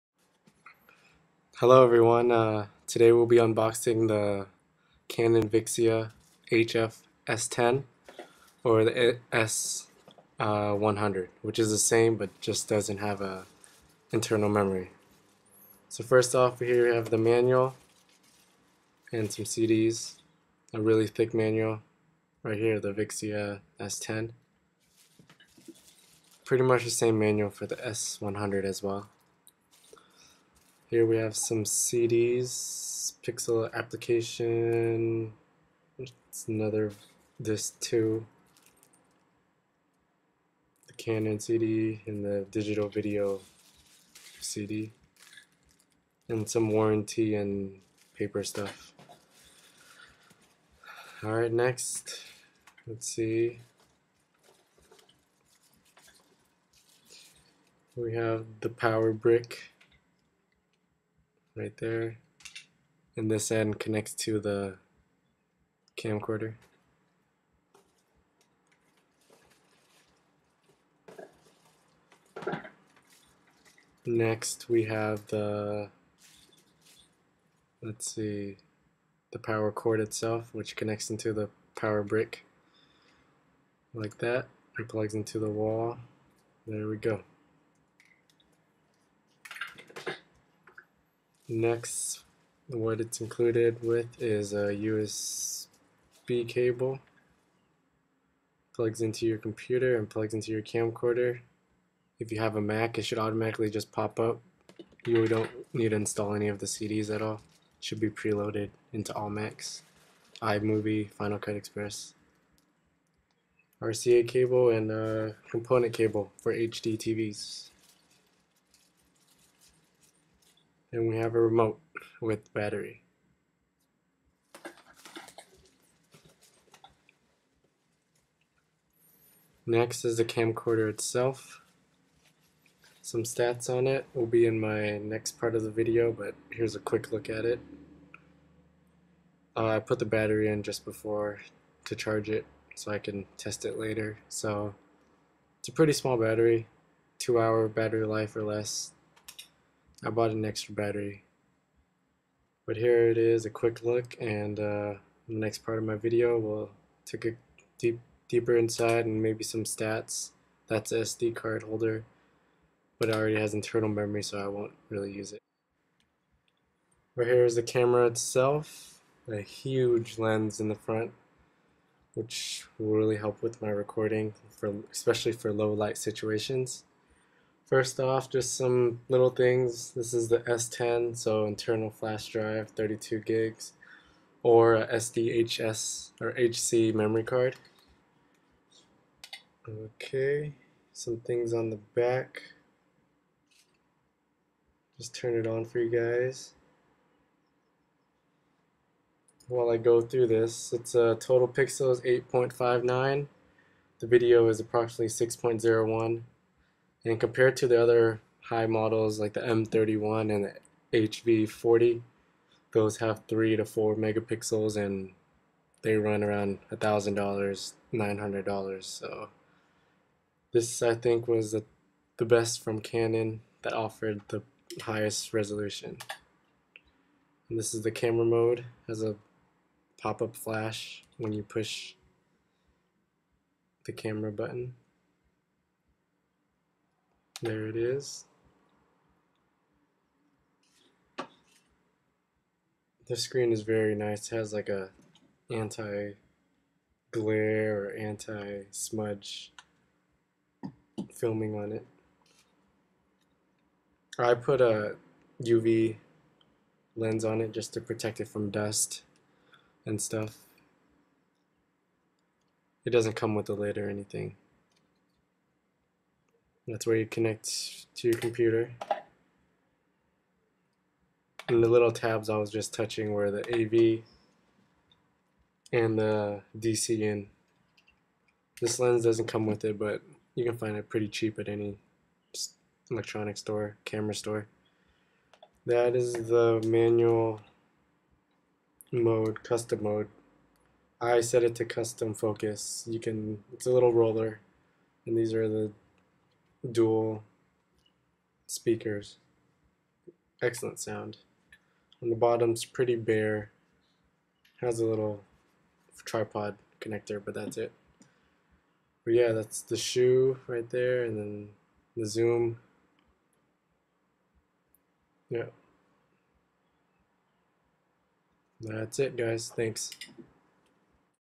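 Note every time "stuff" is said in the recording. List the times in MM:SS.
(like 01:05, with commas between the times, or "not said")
00:48, 04:19.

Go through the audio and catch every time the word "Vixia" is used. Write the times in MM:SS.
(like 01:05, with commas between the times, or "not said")
00:05, 00:22.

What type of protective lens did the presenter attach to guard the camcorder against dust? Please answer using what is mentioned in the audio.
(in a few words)
UV lens.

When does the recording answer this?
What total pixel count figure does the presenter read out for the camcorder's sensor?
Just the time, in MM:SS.
03:22.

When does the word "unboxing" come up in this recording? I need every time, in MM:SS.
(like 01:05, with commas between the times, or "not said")
00:03.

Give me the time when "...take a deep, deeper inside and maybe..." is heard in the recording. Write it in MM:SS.
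02:37.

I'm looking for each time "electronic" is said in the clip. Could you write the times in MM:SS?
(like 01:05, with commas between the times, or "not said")
04:42.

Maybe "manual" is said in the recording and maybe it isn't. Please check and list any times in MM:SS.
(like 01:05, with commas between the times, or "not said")
00:17, 00:21, 00:27, 04:46.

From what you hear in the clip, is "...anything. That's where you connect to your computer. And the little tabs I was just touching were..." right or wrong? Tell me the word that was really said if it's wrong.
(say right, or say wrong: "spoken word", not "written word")
right.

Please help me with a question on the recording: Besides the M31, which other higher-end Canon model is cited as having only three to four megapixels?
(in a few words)
HV40.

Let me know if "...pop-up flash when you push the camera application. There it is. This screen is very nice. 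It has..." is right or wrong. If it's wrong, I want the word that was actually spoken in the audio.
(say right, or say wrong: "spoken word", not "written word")
wrong: "button", not "application".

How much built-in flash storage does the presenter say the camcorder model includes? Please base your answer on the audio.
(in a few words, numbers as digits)
32 gigs.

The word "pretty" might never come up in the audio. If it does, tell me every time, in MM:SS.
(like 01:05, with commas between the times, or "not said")
00:26, 02:25, 04:40, 05:02.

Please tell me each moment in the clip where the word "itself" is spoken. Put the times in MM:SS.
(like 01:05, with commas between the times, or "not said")
01:19, 02:10, 02:48.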